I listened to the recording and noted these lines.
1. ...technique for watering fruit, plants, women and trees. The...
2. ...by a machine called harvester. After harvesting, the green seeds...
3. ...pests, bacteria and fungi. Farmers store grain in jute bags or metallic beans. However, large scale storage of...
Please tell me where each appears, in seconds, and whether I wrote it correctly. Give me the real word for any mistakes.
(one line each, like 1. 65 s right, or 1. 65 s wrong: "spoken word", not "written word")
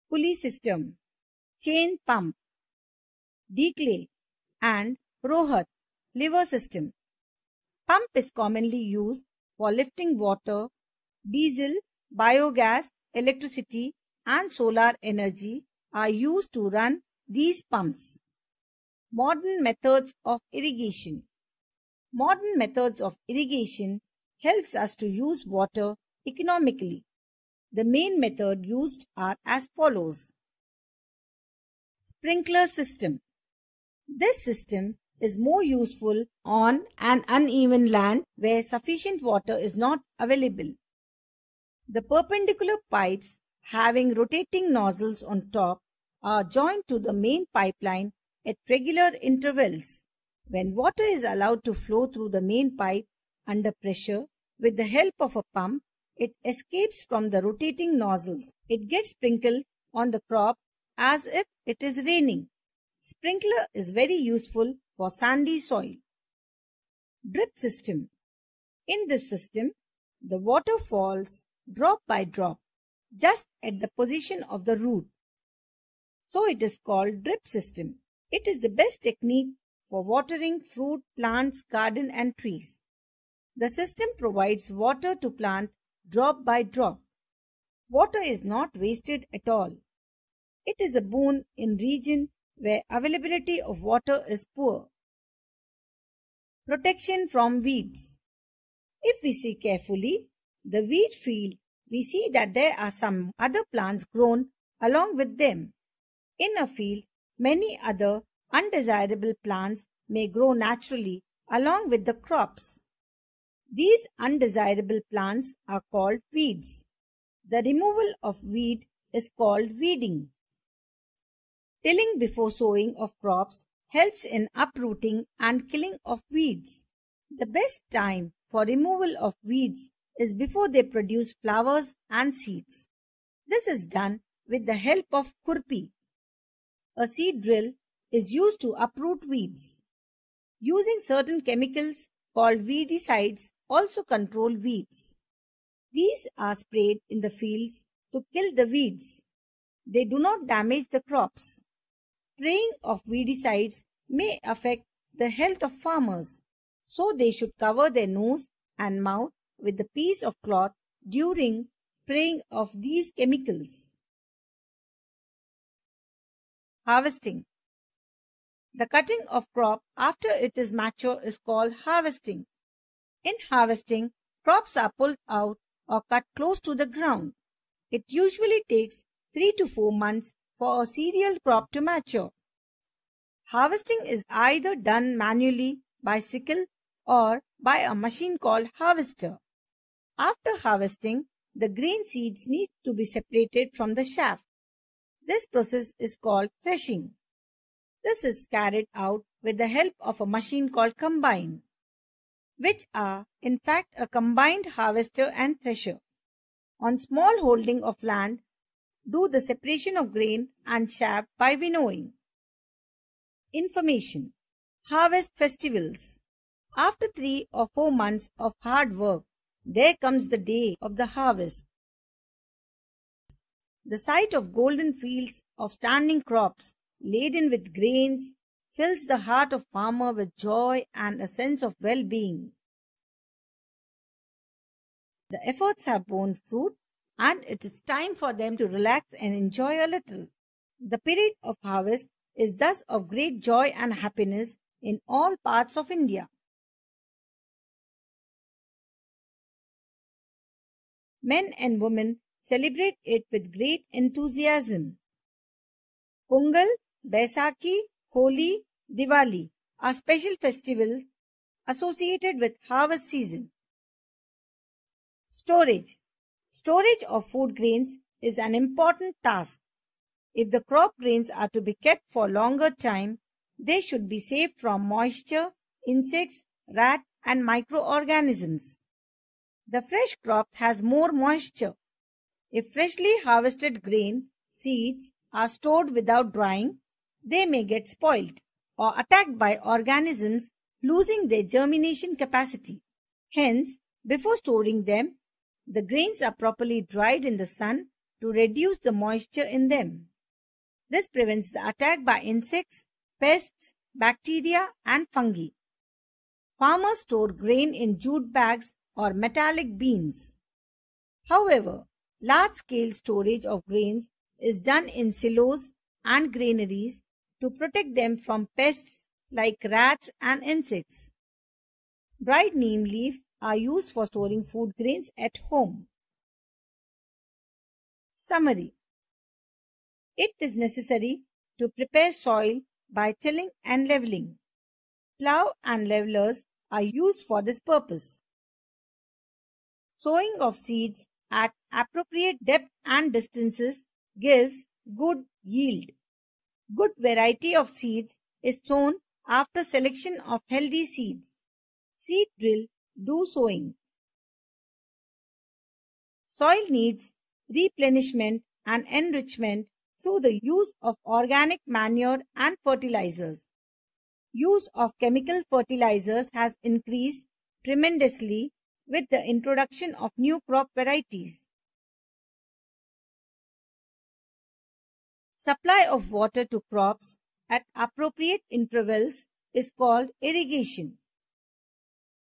1. 79 s wrong: "garden", not "women"
2. 187 s right
3. 303 s right.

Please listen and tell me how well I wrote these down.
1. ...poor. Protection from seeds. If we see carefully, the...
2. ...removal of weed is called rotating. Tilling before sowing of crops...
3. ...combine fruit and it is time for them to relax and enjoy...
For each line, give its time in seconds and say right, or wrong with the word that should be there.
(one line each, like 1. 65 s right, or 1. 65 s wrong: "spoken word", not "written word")
1. 94 s wrong: "weeds", not "seeds"
2. 117 s wrong: "weeding", not "rotating"
3. 236 s wrong: "borne", not "combine".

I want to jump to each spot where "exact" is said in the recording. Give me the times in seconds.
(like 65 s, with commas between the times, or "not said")
not said.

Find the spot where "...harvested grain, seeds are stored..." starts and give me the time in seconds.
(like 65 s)
283 s.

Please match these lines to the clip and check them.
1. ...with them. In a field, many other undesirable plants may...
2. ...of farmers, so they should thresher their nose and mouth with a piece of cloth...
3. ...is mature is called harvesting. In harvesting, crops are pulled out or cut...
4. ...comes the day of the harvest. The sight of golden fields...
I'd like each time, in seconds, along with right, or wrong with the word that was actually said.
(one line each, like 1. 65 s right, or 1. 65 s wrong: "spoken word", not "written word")
1. 105 s right
2. 155 s wrong: "cover", not "thresher"
3. 170 s right
4. 219 s right.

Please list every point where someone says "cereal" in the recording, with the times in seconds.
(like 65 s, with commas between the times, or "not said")
180 s.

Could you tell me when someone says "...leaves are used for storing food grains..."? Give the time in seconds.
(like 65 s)
322 s.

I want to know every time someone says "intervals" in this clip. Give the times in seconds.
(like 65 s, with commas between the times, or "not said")
49 s, 378 s.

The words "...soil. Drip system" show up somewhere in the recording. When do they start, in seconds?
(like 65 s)
65 s.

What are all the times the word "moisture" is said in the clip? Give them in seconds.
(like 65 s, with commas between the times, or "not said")
274 s, 281 s, 298 s.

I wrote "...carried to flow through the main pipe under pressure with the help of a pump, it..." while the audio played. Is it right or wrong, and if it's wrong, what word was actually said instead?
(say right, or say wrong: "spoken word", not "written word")
wrong: "allowed", not "carried".